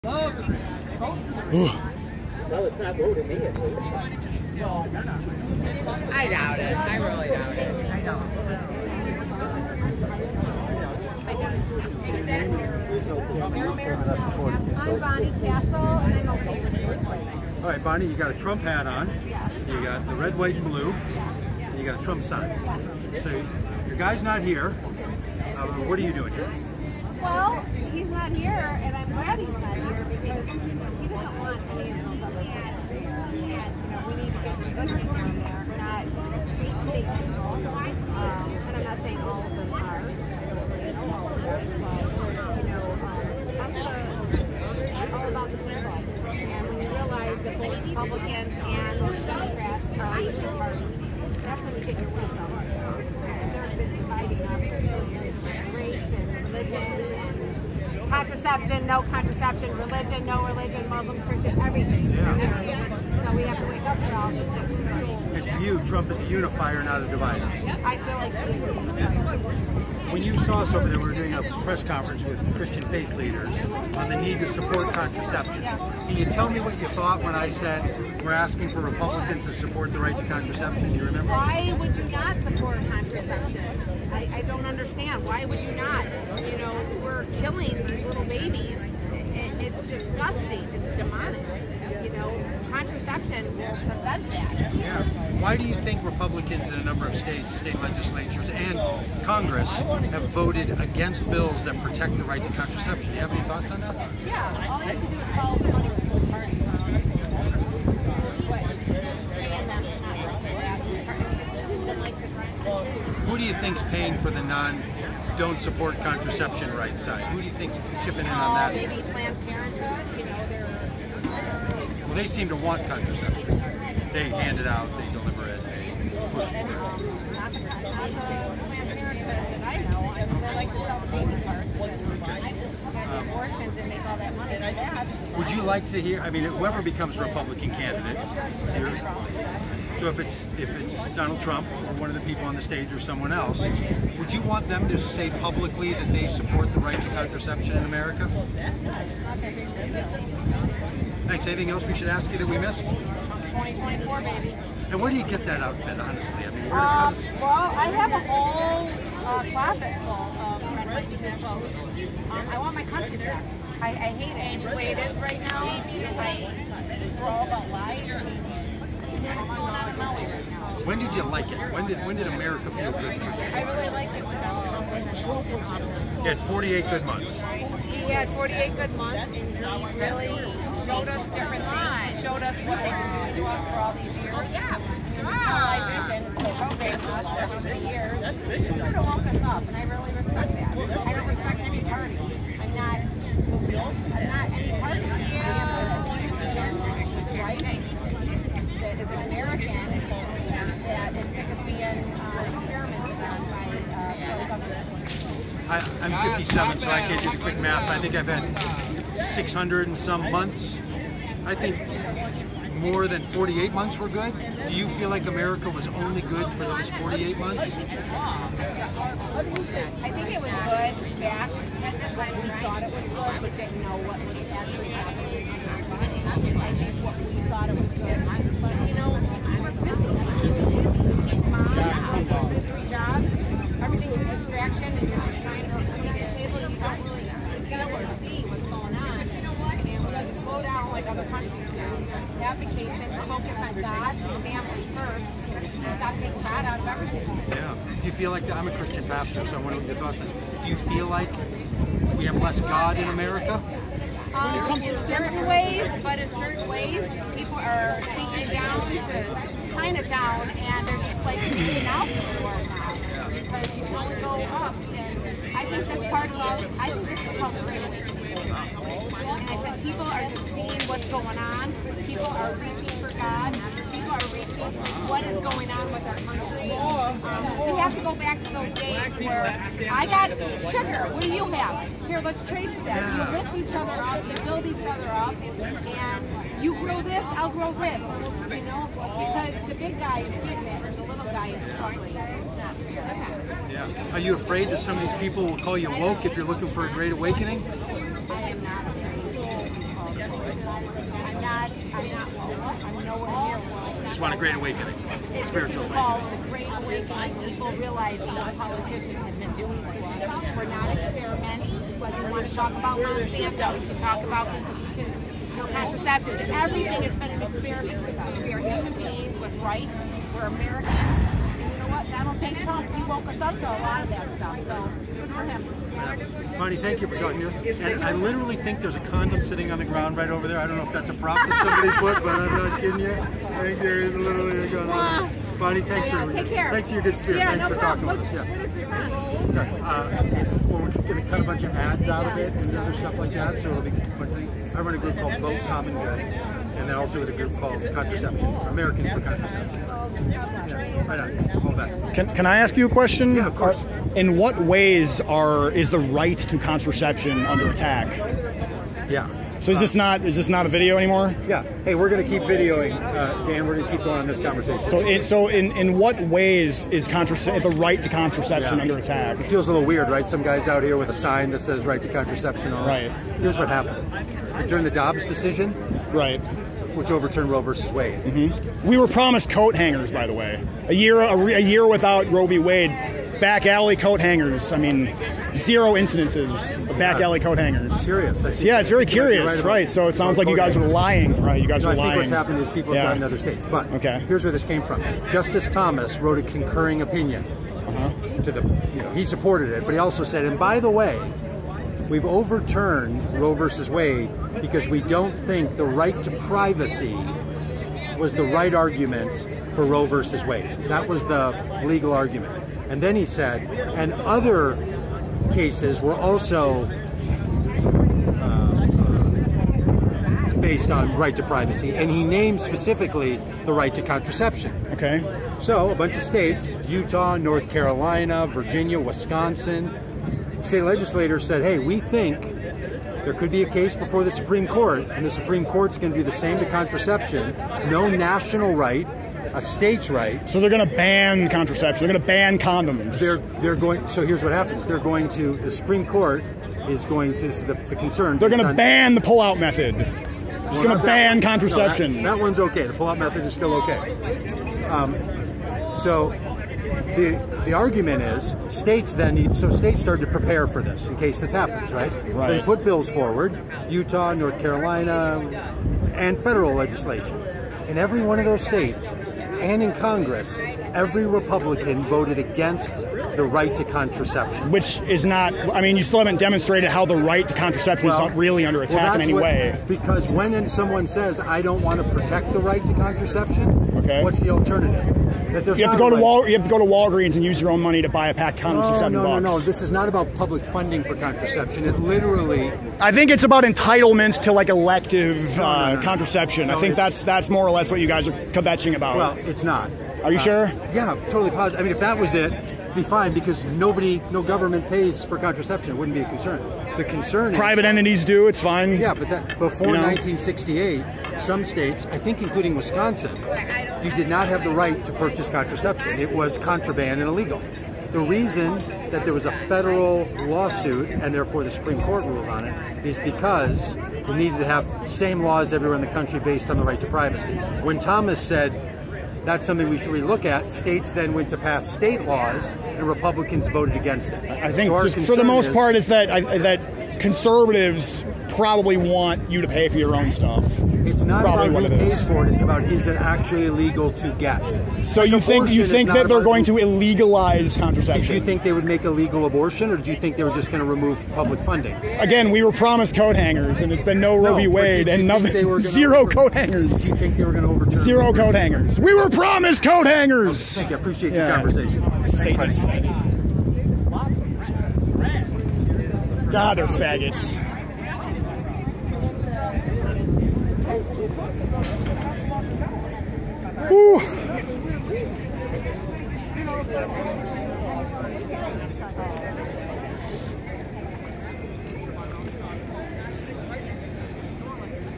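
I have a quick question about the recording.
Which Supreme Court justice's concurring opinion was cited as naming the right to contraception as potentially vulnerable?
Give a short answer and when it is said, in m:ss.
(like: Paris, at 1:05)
Justice Thomas, at 6:35.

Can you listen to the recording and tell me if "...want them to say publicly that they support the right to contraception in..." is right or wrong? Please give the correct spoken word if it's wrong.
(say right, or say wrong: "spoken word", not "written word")
right.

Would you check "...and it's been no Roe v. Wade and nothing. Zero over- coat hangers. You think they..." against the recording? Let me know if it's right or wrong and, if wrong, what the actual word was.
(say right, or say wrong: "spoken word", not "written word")
right.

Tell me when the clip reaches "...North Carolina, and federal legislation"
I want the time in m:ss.
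7:44.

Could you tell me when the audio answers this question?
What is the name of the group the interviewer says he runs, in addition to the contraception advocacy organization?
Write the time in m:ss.
5:45.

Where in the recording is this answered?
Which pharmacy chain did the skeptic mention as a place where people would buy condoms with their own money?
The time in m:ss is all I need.
8:06.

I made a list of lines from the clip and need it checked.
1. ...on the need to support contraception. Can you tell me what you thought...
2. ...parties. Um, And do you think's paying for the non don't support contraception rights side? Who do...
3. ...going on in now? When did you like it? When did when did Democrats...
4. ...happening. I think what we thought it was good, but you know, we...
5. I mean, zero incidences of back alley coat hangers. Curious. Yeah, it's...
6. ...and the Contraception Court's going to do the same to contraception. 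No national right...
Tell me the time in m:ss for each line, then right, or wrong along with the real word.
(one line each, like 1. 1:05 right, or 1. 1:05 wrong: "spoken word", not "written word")
1. 1:13 right
2. 1:46 wrong: "Who", not "And"
3. 2:49 wrong: "America", not "Democrats"
4. 3:44 right
5. 6:24 right
6. 7:15 wrong: "Supreme", not "Contraception".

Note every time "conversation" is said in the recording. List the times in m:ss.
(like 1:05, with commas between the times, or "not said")
6:04, 9:21.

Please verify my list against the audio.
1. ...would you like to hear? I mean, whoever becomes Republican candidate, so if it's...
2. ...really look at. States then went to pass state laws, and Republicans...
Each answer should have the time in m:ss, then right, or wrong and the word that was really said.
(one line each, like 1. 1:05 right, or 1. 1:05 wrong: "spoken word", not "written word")
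1. 2:15 right
2. 8:50 right.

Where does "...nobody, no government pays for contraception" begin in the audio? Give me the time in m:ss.
8:23.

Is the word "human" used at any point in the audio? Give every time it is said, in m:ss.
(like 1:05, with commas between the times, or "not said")
5:18.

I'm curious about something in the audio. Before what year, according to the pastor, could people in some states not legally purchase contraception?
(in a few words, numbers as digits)
1968.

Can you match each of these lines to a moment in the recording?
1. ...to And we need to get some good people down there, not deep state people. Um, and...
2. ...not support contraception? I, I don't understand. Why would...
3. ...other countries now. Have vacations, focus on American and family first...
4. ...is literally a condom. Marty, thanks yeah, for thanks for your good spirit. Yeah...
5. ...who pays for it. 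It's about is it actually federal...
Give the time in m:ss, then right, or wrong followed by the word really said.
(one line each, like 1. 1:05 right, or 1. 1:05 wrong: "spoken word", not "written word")
1. 0:32 right
2. 1:22 right
3. 4:01 wrong: "God", not "American"
4. 5:34 right
5. 9:01 wrong: "illegal", not "federal".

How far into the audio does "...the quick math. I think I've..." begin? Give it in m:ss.
3:27.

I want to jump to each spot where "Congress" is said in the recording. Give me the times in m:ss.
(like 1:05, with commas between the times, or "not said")
1:39, 7:49.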